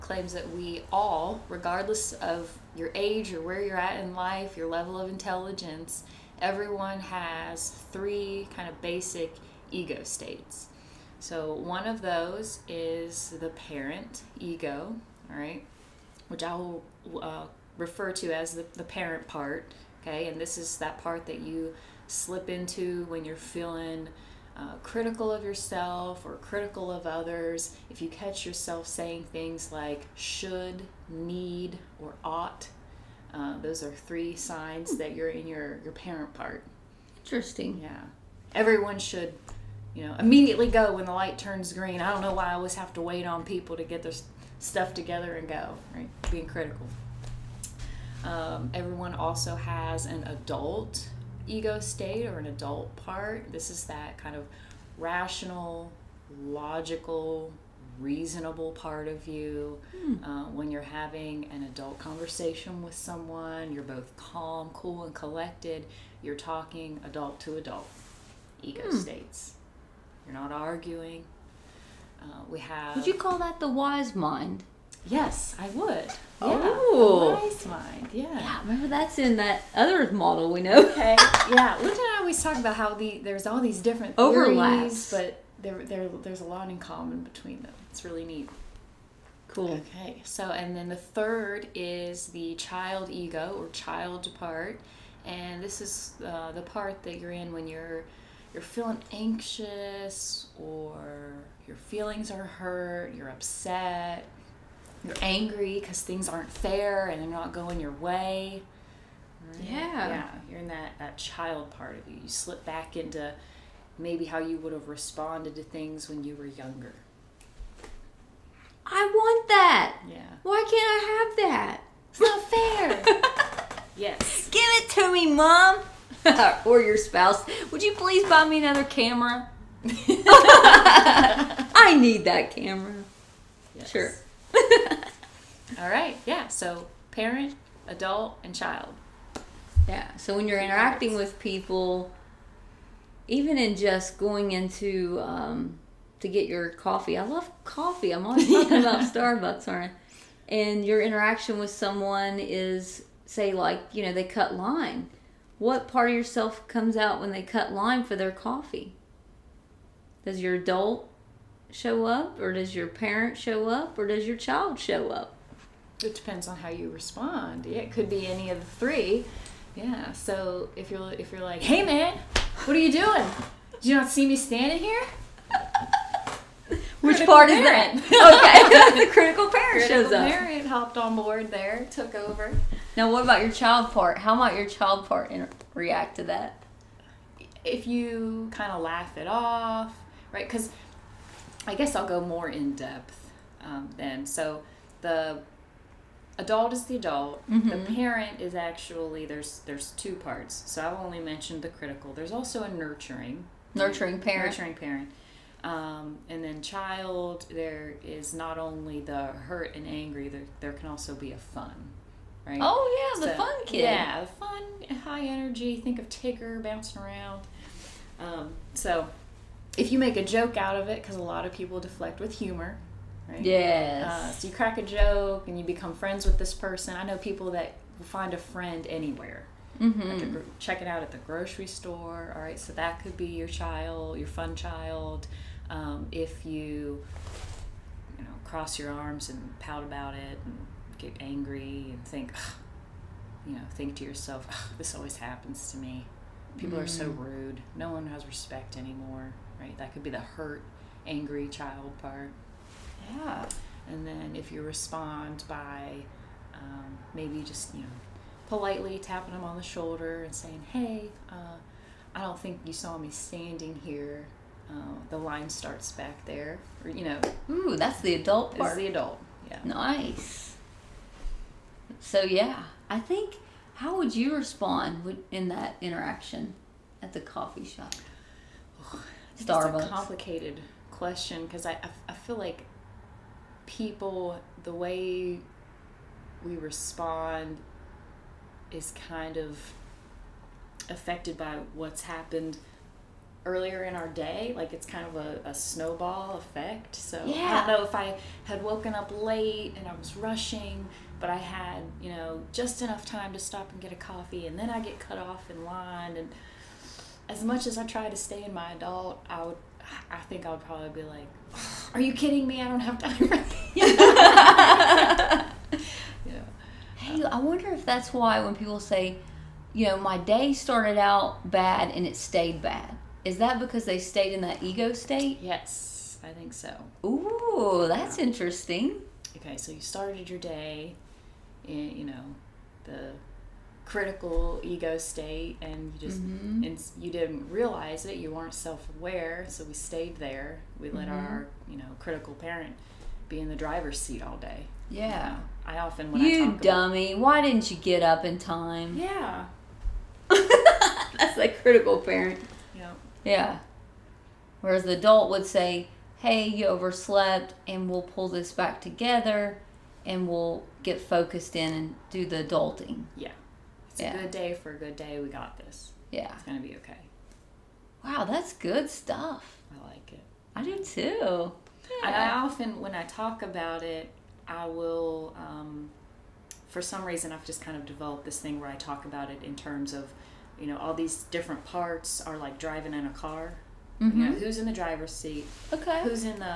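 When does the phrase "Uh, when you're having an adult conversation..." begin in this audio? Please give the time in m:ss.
1:00.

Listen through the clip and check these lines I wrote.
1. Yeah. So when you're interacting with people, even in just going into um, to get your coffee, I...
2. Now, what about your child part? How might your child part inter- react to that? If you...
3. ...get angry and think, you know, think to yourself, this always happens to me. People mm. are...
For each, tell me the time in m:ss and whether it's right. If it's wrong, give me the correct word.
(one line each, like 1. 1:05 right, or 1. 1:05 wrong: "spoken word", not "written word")
1. 2:19 right
2. 3:02 right
3. 4:00 right.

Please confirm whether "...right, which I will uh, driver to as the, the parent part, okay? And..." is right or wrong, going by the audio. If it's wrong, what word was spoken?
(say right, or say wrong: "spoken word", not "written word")
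wrong: "refer", not "driver".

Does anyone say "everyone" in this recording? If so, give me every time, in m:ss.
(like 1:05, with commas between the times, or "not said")
0:06, 0:38, 0:48.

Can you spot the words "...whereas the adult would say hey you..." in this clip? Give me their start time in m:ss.
5:54.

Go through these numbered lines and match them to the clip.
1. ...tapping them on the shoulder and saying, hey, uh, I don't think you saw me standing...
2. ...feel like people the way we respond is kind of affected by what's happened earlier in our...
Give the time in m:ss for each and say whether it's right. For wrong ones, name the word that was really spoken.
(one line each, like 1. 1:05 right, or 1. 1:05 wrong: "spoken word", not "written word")
1. 4:18 right
2. 4:42 right.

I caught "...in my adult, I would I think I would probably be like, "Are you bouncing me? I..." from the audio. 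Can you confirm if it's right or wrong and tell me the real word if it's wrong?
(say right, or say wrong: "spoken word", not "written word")
wrong: "kidding", not "bouncing".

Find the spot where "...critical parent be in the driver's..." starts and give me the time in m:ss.
5:41.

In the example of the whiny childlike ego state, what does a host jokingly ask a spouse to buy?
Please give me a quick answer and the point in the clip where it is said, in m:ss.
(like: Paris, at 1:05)
Another camera, at 2:08.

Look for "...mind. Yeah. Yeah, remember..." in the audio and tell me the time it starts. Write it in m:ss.
1:17.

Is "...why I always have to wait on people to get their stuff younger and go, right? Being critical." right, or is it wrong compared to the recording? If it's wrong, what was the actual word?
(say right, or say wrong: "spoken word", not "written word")
wrong: "together", not "younger".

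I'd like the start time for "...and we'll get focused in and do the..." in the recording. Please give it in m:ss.
6:00.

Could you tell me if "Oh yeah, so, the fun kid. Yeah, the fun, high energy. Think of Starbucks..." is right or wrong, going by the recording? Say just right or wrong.
wrong.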